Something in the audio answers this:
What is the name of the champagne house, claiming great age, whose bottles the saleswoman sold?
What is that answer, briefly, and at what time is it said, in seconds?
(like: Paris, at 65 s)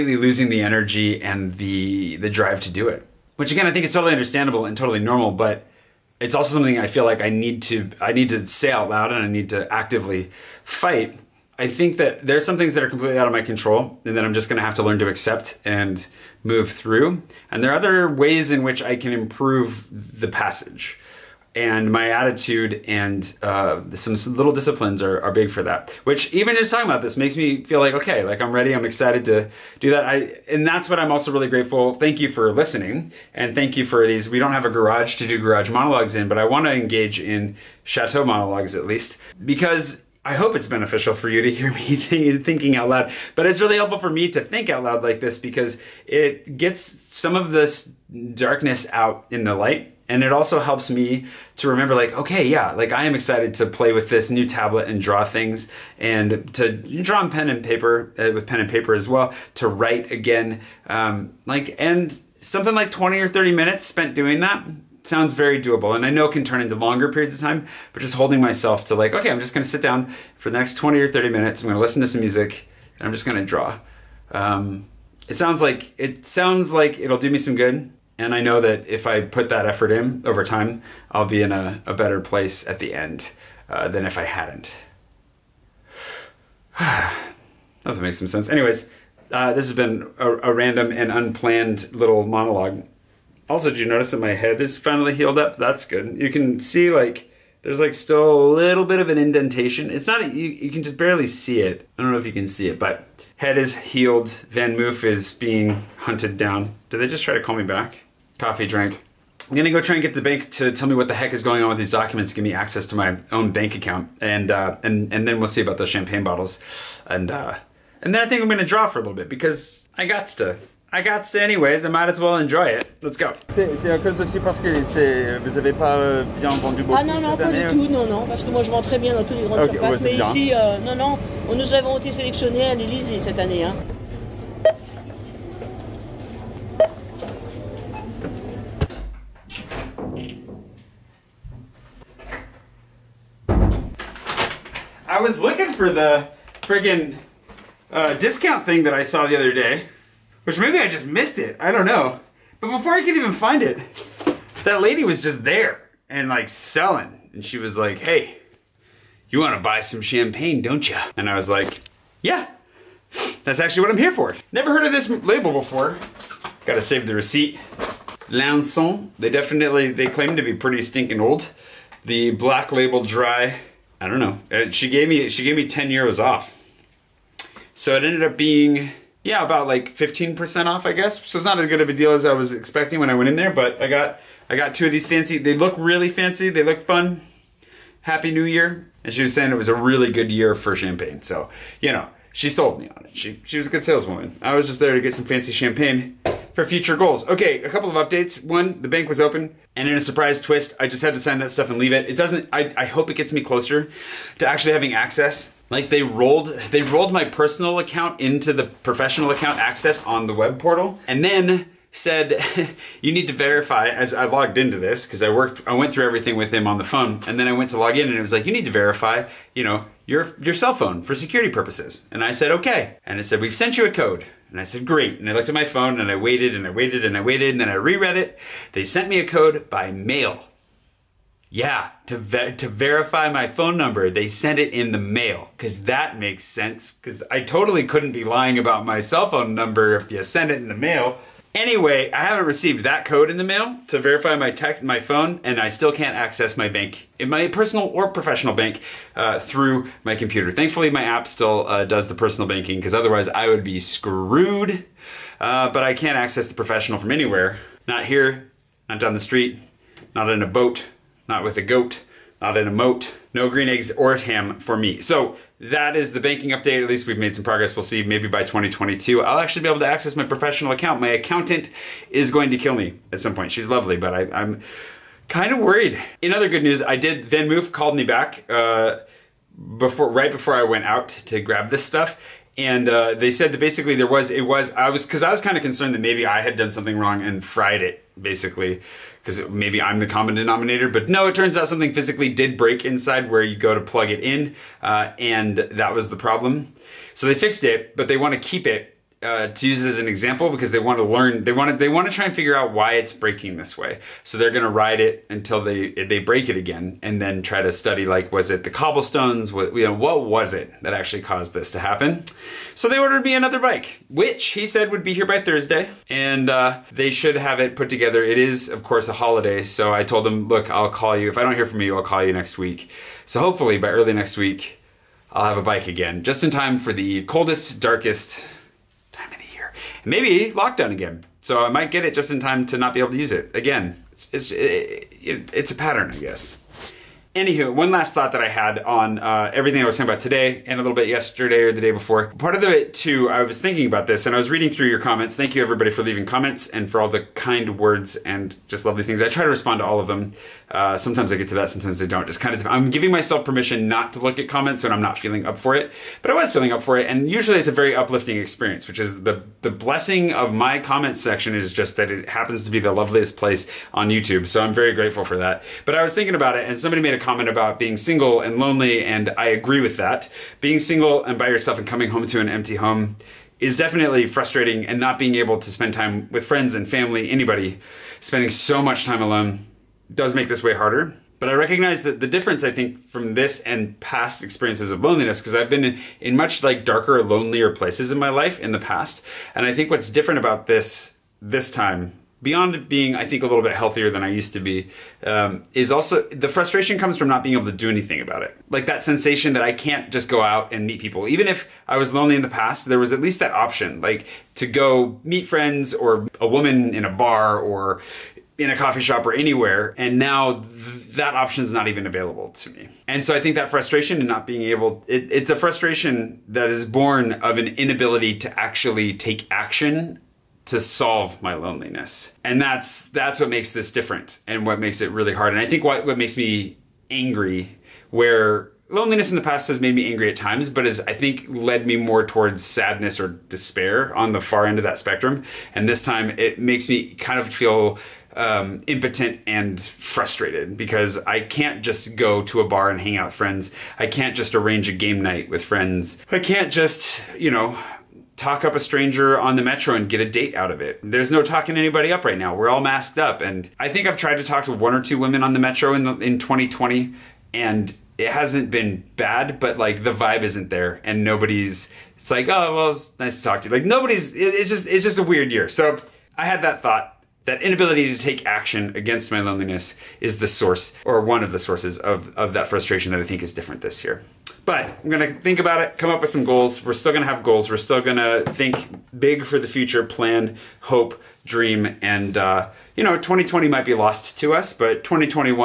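Lanson, at 168 s.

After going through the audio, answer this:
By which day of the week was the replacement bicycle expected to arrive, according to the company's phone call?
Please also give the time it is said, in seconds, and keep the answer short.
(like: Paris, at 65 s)
Thursday, at 315 s.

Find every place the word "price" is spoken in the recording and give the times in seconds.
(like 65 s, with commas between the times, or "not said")
not said.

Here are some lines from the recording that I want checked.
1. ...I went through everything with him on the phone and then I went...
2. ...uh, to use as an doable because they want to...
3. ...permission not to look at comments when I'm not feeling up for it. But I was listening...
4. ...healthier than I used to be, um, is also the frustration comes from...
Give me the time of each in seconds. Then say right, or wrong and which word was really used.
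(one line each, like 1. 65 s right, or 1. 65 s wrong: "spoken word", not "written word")
1. 215 s right
2. 299 s wrong: "example", not "doable"
3. 353 s wrong: "feeling", not "listening"
4. 393 s right.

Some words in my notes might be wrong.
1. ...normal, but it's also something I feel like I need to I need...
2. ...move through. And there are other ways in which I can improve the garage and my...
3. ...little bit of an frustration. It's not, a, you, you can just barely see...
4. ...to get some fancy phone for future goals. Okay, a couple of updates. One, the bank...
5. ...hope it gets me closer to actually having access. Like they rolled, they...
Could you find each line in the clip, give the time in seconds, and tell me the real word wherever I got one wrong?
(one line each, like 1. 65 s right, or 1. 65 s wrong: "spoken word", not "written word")
1. 4 s right
2. 16 s wrong: "passage", not "garage"
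3. 98 s wrong: "indentation", not "frustration"
4. 194 s wrong: "champagne", not "phone"
5. 202 s right.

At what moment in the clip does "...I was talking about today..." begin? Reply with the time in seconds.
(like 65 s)
339 s.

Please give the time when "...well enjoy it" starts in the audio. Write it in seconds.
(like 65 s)
122 s.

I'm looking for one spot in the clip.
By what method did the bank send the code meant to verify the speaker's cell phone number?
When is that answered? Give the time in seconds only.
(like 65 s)
229 s.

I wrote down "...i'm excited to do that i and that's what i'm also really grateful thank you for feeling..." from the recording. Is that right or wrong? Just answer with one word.
wrong.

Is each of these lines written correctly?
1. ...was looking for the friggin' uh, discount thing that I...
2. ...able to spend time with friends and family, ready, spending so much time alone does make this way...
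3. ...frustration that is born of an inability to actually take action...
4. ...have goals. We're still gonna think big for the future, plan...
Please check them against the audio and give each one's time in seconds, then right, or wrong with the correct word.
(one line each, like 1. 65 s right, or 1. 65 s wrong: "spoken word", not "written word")
1. 145 s right
2. 375 s wrong: "anybody", not "ready"
3. 415 s right
4. 477 s right.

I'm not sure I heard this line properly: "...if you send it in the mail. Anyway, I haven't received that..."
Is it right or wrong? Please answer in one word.
right.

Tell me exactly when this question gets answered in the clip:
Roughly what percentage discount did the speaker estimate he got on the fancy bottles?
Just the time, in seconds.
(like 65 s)
179 s.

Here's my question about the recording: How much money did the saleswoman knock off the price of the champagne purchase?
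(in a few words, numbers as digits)
10 euros.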